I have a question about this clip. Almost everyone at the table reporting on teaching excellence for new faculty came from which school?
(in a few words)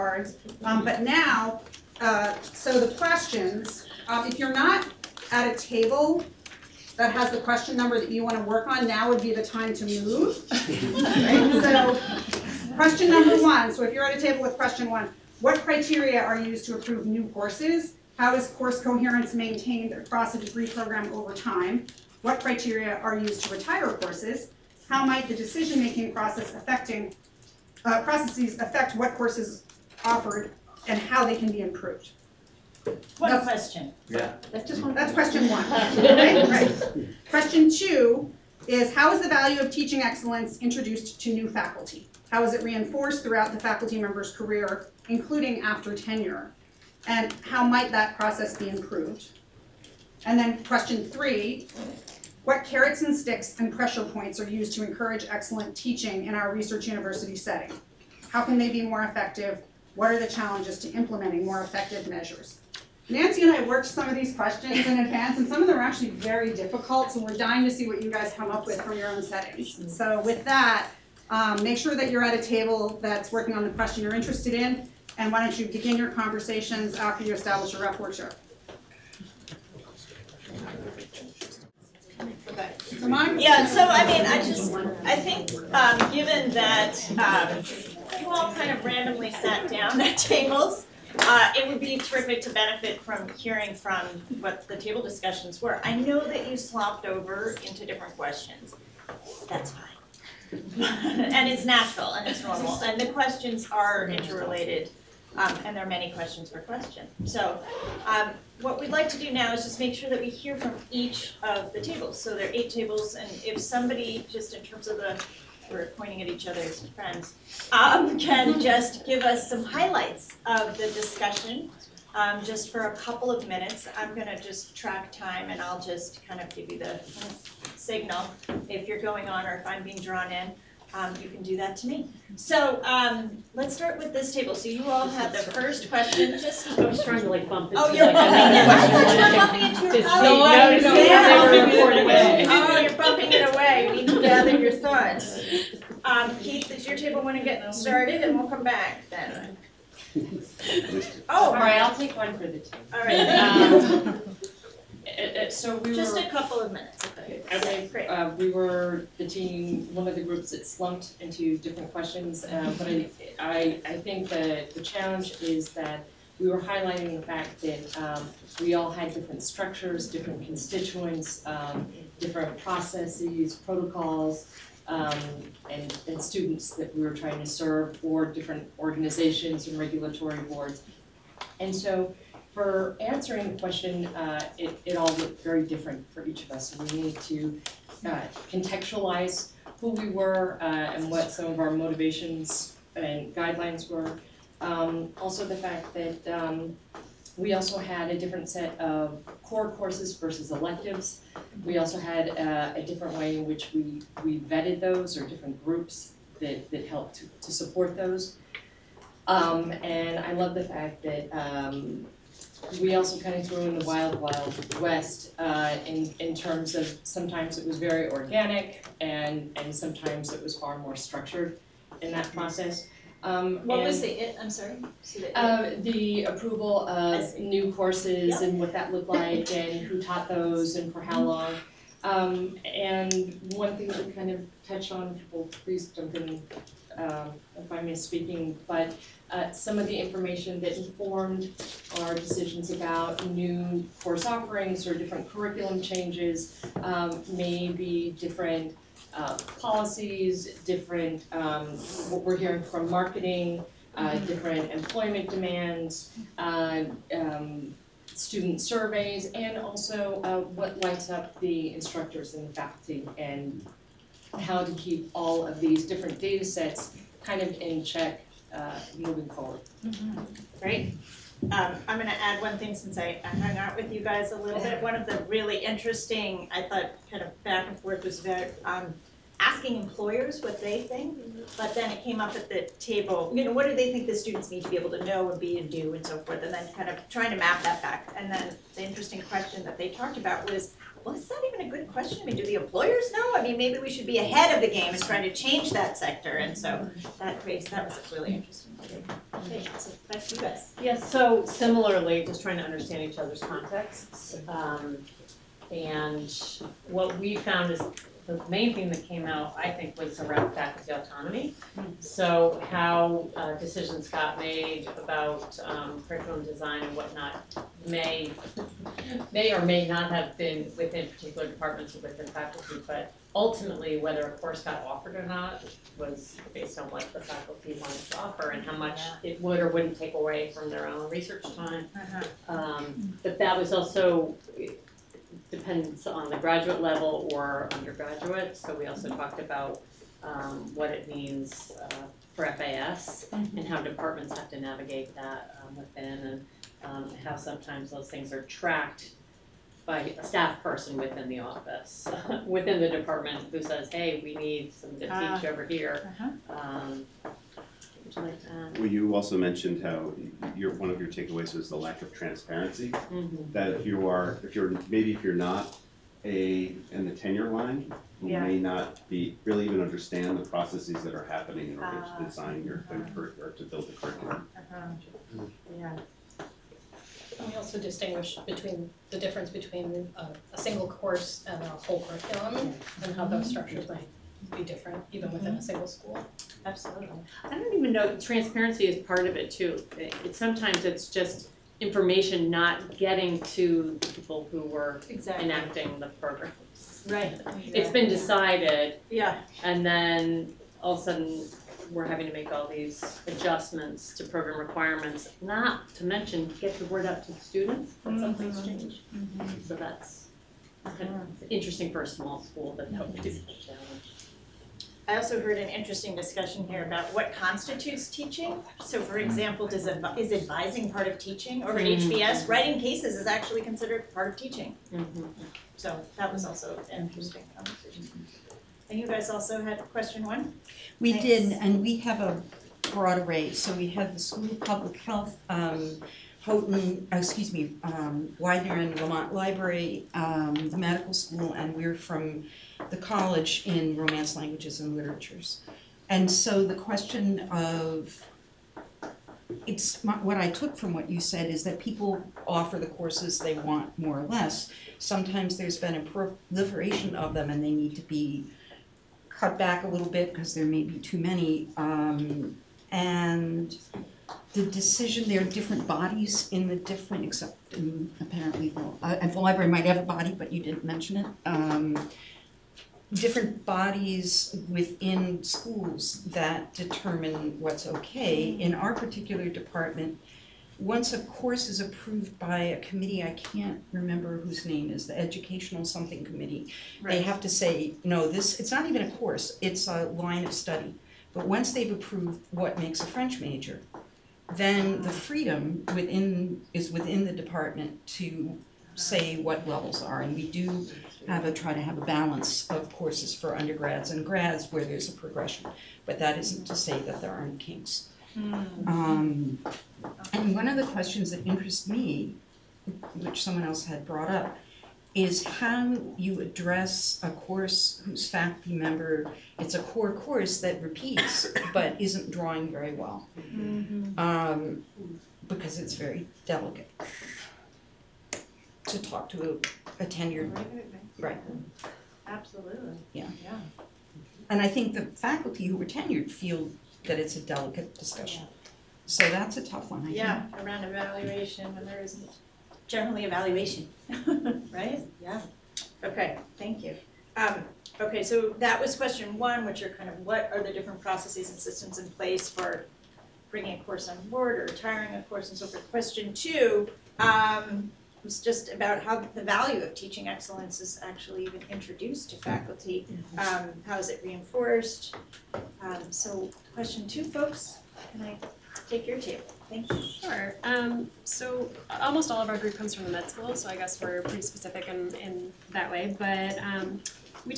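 med school.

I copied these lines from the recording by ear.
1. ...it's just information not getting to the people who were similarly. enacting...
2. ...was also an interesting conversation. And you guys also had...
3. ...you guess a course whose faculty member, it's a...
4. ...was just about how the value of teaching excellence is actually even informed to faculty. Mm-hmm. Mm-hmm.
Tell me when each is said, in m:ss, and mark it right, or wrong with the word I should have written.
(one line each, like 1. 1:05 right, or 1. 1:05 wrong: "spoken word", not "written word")
1. 6:30 wrong: "exactly", not "similarly"
2. 7:06 right
3. 8:36 wrong: "address", not "guess"
4. 9:18 wrong: "introduced", not "informed".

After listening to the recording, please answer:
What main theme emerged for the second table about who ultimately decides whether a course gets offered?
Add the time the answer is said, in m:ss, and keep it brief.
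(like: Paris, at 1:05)
faculty autonomy, at 5:10.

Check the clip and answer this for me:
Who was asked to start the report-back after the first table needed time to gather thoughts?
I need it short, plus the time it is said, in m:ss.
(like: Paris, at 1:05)
Keith, at 2:26.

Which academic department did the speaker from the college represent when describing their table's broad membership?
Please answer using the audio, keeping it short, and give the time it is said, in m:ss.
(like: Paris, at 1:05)
Romance Languages and Literatures, at 7:23.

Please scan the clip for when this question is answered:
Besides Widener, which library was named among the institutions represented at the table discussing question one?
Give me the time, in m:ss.
7:18.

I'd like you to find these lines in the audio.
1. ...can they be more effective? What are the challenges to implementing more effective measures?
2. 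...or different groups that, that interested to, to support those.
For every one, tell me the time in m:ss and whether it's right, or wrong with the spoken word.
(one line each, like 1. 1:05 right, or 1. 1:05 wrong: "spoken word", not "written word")
1. 0:58 right
2. 3:25 wrong: "helped", not "interested".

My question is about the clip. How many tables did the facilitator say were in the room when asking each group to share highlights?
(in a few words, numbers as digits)
8.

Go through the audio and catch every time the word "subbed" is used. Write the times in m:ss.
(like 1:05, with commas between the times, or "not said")
not said.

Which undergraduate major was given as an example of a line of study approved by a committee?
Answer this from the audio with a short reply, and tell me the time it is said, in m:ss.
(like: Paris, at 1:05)
French, at 8:13.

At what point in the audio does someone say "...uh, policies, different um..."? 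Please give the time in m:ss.
4:09.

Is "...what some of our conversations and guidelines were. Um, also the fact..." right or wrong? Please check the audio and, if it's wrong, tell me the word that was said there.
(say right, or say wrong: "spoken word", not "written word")
wrong: "motivations", not "conversations".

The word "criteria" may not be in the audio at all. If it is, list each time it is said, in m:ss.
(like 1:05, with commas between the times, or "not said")
0:15, 0:22.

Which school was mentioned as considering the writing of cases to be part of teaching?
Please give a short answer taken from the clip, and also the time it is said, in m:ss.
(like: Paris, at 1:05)
HBS, at 7:02.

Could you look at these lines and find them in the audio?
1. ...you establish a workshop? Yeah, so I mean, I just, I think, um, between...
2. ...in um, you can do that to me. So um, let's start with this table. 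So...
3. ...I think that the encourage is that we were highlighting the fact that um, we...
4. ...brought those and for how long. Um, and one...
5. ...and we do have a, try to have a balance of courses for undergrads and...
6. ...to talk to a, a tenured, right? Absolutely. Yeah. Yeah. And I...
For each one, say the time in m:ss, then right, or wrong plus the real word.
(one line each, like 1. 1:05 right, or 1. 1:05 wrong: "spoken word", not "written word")
1. 1:17 wrong: "given", not "between"
2. 2:10 right
3. 2:43 wrong: "challenge", not "encourage"
4. 3:50 wrong: "taught", not "brought"
5. 8:20 right
6. 8:48 right.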